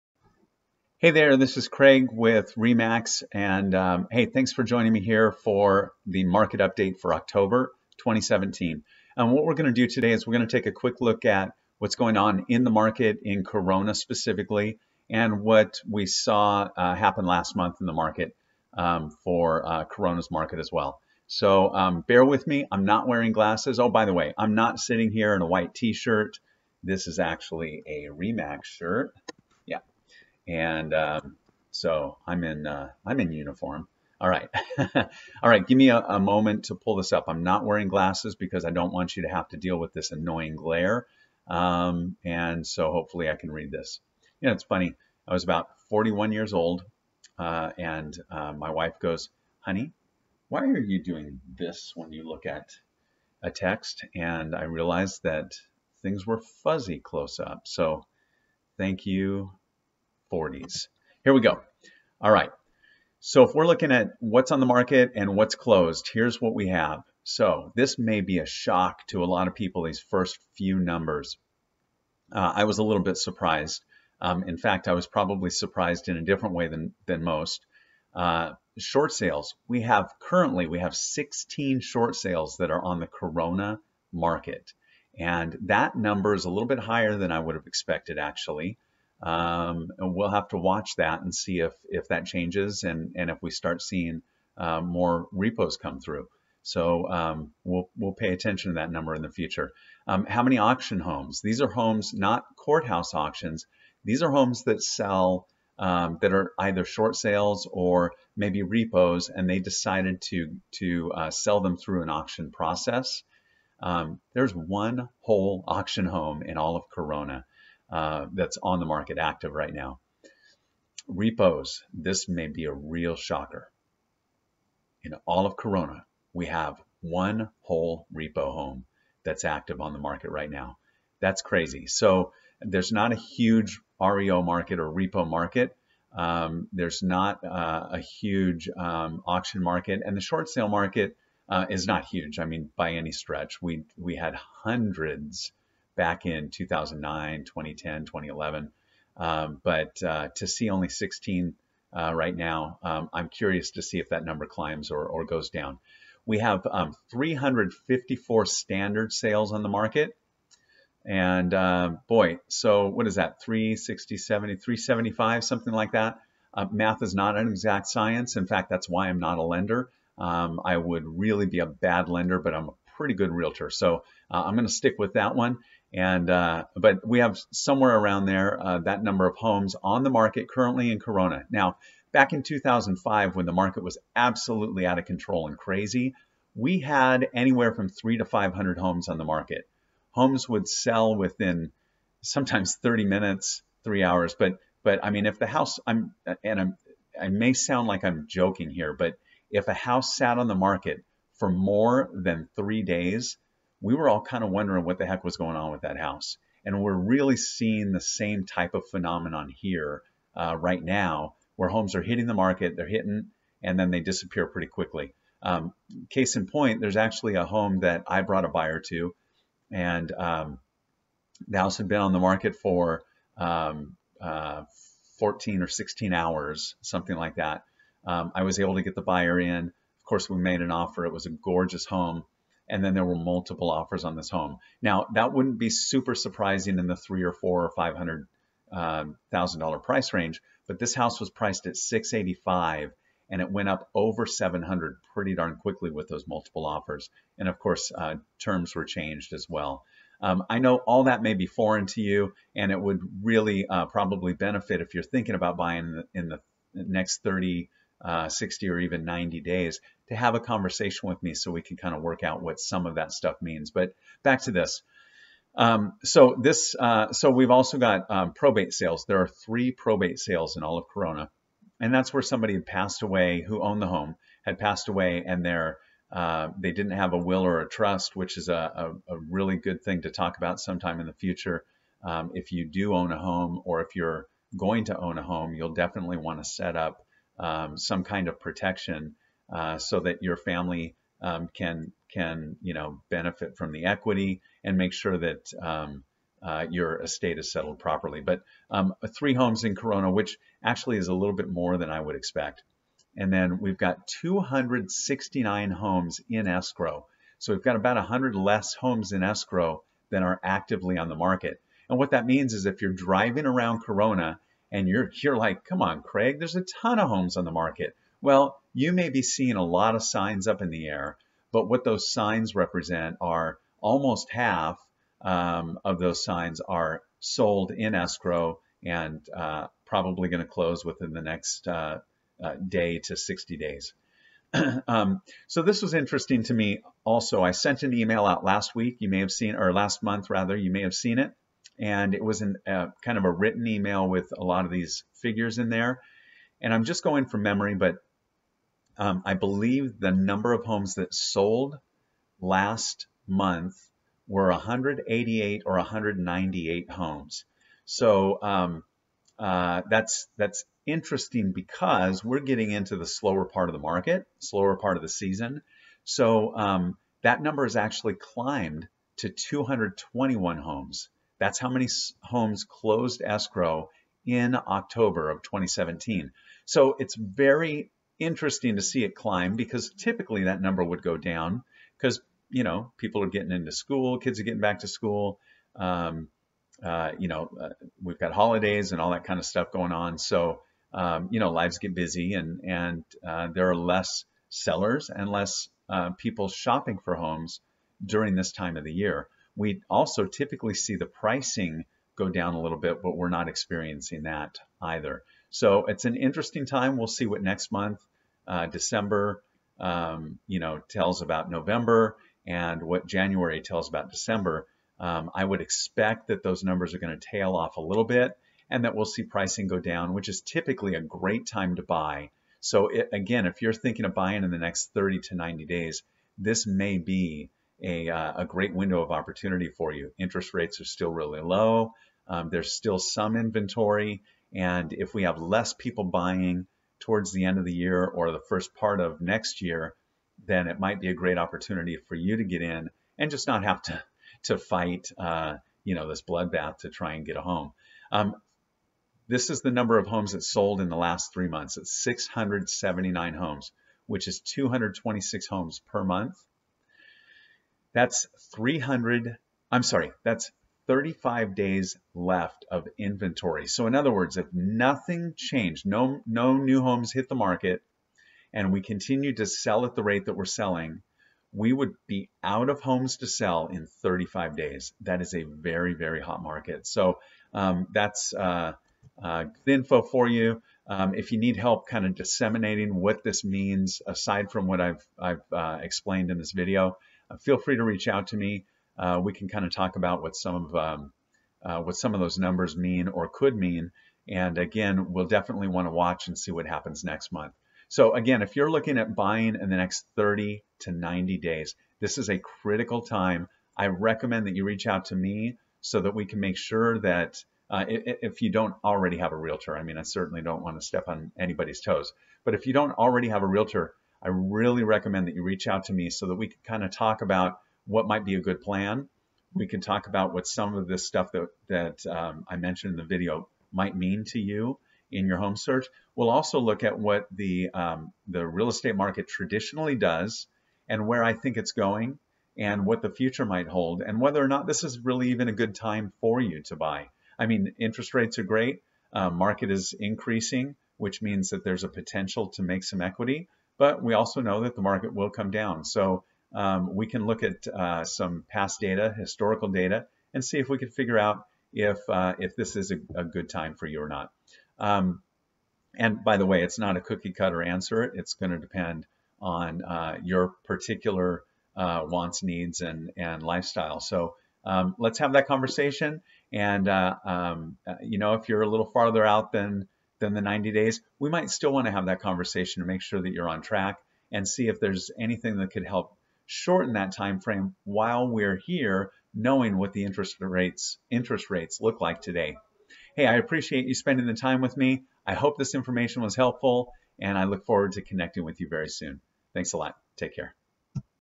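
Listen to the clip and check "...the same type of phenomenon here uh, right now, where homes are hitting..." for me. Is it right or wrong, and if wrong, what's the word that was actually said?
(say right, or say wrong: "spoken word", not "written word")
right.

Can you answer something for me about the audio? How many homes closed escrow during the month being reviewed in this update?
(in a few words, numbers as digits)
221.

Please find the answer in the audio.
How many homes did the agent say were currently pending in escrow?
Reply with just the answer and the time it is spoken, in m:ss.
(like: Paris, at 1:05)
269, at 5:04.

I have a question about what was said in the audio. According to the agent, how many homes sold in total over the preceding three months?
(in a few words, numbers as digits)
679.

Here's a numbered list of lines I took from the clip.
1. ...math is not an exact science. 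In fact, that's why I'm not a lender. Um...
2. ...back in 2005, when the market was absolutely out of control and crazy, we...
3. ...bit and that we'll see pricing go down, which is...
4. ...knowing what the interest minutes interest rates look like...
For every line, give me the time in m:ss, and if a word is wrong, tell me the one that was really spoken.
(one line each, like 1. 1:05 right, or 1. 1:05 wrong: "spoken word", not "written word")
1. 2:46 right
2. 3:02 right
3. 6:58 right
4. 9:39 wrong: "rates", not "minutes".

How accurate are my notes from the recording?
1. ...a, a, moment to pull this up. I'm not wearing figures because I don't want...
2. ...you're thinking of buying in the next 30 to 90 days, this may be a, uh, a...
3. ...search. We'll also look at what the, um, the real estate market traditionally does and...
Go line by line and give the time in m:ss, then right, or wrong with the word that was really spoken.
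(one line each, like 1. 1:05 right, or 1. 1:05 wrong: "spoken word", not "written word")
1. 0:35 wrong: "glasses", not "figures"
2. 7:03 right
3. 8:45 right.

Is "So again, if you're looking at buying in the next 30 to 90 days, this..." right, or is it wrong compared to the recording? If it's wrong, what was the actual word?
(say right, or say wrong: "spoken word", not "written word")
right.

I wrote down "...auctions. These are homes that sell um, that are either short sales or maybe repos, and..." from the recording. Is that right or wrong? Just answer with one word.
right.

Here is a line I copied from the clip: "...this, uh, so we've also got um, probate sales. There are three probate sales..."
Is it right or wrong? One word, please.
right.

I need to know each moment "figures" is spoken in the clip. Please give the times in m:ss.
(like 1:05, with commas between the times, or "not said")
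5:45, 9:10.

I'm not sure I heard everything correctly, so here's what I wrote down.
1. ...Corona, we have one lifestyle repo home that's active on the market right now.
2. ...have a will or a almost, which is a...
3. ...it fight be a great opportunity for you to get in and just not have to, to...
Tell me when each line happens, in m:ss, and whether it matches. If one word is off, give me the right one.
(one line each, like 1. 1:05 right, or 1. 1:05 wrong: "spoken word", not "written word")
1. 2:05 wrong: "whole", not "lifestyle"
2. 4:36 wrong: "trust", not "almost"
3. 7:20 wrong: "might", not "fight".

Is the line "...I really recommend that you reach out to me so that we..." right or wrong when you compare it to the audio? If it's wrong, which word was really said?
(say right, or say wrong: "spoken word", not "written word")
right.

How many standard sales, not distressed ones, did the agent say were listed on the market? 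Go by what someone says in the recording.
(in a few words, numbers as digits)
354.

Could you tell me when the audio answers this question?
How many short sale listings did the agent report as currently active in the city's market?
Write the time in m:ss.
1:20.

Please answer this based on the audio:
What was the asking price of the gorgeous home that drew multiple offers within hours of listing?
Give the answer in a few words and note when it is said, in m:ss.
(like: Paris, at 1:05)
685,000, at 4:01.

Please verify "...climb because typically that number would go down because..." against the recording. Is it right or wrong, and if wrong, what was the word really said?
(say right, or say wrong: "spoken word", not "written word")
right.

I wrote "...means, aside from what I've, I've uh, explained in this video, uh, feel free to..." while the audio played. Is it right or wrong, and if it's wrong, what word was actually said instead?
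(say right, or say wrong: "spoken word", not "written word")
right.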